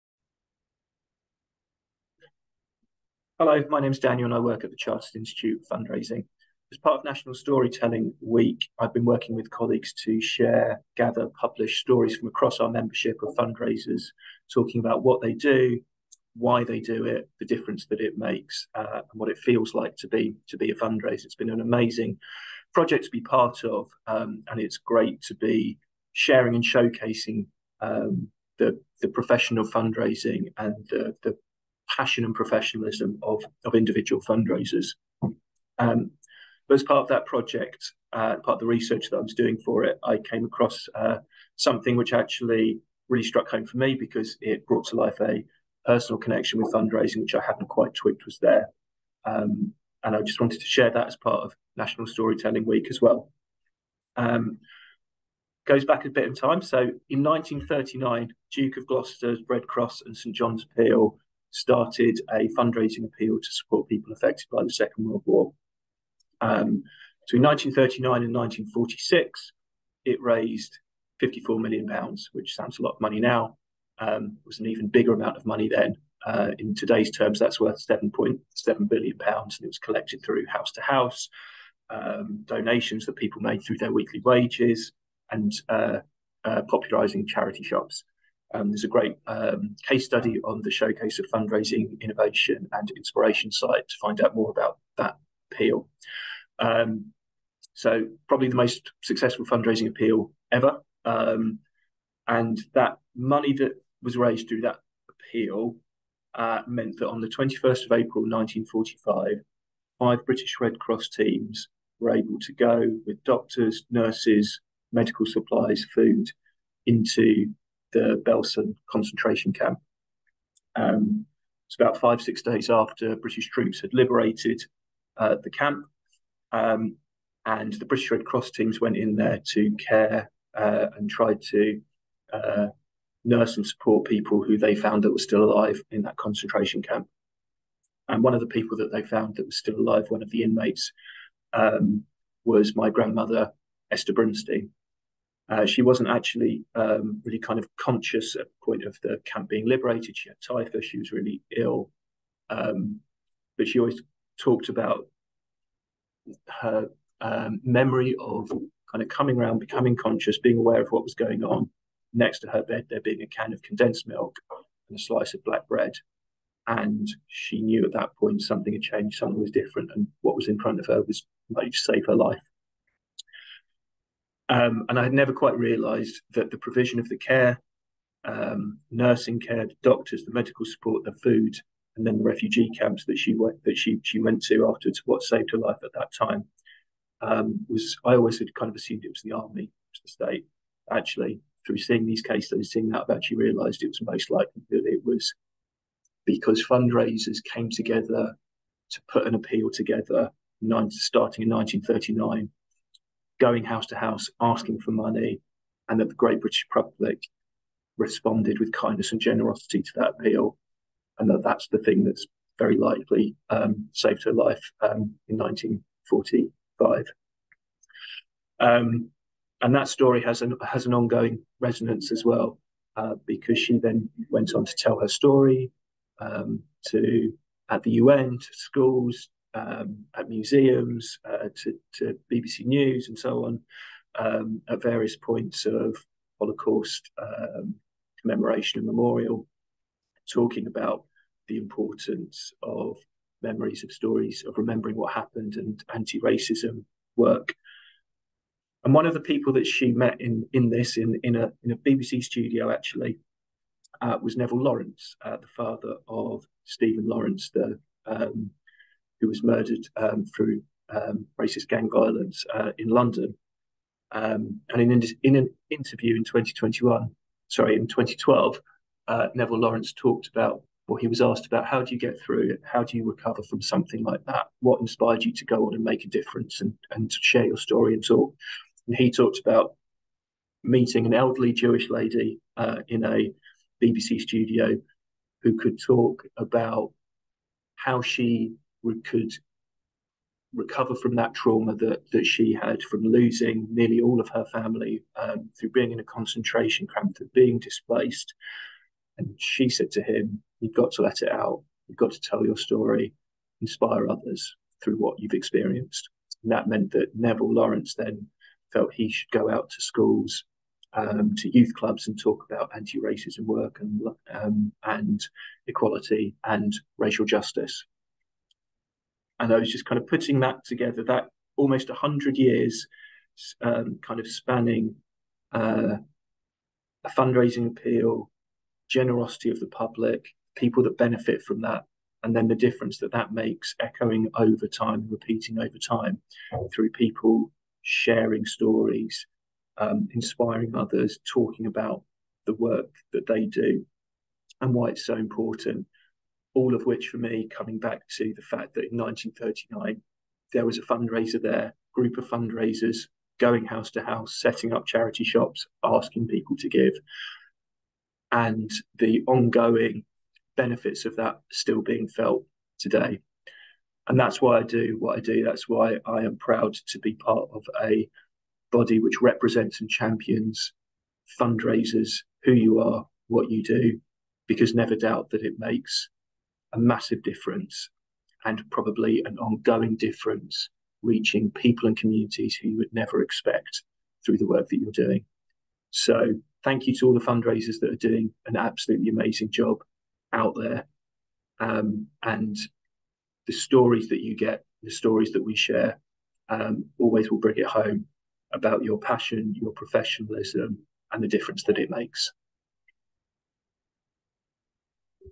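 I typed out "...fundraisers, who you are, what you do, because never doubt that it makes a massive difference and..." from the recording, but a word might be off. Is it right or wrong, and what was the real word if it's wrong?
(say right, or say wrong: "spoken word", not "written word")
right.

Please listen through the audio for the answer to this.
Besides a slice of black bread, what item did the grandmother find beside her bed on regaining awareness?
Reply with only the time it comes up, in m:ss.
2:43.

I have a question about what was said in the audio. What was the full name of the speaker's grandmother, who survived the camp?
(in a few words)
Esther Brunstein.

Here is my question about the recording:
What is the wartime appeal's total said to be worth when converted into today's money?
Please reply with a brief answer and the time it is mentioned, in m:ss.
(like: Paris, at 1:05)
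7.7 billion pounds, at 1:17.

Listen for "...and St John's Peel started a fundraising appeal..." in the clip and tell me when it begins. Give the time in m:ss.
1:00.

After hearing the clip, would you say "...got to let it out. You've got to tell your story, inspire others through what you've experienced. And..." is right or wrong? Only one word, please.
right.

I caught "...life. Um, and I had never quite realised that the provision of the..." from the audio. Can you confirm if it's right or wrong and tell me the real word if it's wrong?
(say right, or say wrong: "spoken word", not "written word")
right.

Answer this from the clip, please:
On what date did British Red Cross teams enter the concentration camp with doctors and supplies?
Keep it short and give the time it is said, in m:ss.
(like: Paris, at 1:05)
21st of April 1945, at 1:47.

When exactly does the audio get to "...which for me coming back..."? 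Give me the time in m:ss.
5:46.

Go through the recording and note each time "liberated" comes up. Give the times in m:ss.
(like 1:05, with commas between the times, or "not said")
2:03, 2:29.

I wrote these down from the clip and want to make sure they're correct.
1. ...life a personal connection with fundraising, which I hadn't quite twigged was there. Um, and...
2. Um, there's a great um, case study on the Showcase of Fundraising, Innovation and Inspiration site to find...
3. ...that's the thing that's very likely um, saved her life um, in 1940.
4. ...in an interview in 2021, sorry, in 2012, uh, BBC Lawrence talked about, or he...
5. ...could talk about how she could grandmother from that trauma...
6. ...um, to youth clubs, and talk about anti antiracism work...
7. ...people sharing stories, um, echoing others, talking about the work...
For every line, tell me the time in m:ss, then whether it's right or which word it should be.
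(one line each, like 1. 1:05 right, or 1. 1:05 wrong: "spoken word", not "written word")
1. 0:44 right
2. 1:28 right
3. 3:31 wrong: "1945", not "1940"
4. 4:25 wrong: "Neville", not "BBC"
5. 4:45 wrong: "recover", not "grandmother"
6. 5:10 wrong: "racism", not "antiracism"
7. 5:36 wrong: "inspiring", not "echoing".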